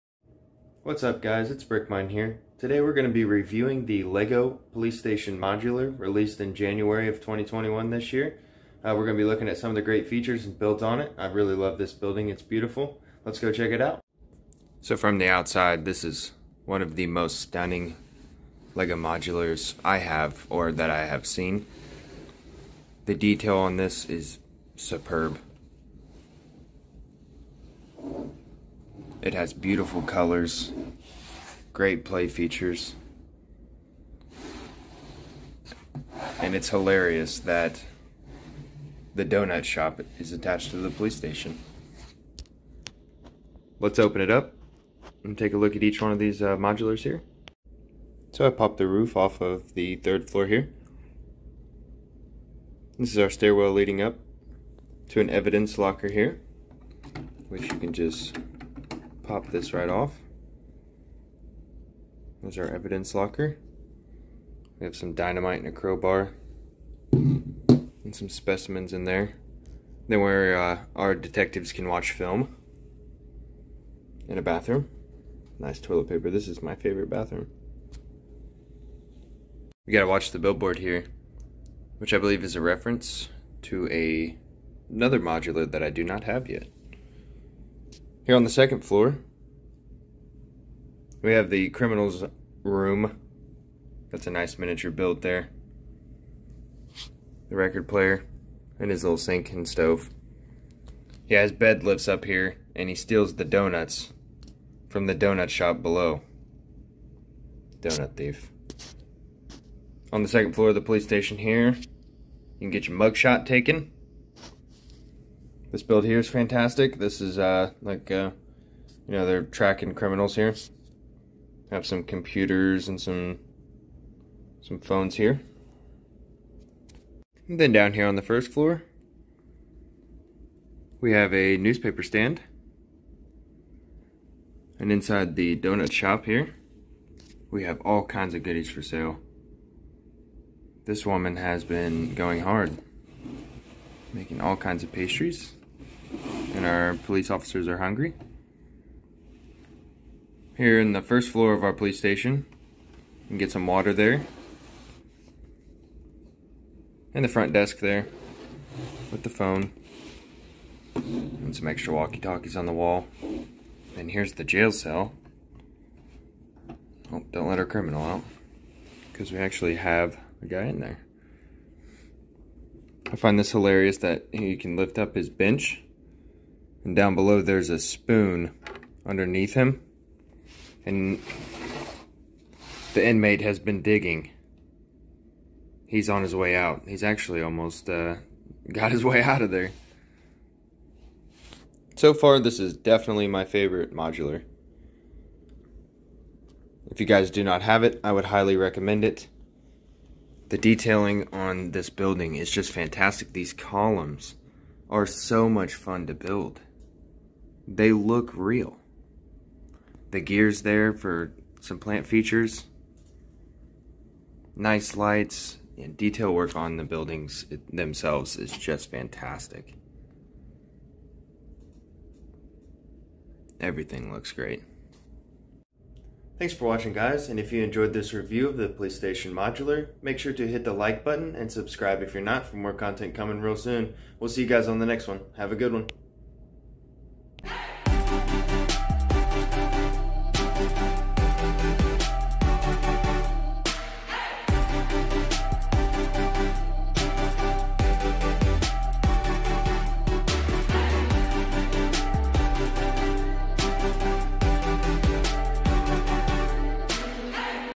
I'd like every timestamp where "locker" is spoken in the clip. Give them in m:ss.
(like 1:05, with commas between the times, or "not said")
0:55, 1:03.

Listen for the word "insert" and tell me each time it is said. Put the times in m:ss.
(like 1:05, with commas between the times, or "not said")
not said.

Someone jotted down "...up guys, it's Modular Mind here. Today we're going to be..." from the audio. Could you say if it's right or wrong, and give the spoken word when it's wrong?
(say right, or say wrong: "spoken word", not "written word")
wrong: "Brick", not "Modular".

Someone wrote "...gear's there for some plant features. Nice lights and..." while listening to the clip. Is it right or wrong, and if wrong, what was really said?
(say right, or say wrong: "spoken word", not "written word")
right.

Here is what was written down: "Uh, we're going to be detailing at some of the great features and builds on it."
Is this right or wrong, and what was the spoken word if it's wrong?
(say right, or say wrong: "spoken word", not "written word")
wrong: "looking", not "detailing".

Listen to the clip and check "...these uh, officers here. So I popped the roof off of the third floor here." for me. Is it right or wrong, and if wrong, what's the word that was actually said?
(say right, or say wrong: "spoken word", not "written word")
wrong: "modulars", not "officers".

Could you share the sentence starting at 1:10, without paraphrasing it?
Then where uh, our detectives can watch film.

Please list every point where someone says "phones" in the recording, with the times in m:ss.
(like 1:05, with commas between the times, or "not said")
2:04, 2:39.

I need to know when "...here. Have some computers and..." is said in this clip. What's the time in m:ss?
2:00.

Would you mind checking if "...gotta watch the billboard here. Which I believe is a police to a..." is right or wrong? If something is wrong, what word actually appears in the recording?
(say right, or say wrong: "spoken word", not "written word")
wrong: "reference", not "police".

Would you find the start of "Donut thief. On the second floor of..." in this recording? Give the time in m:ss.
1:47.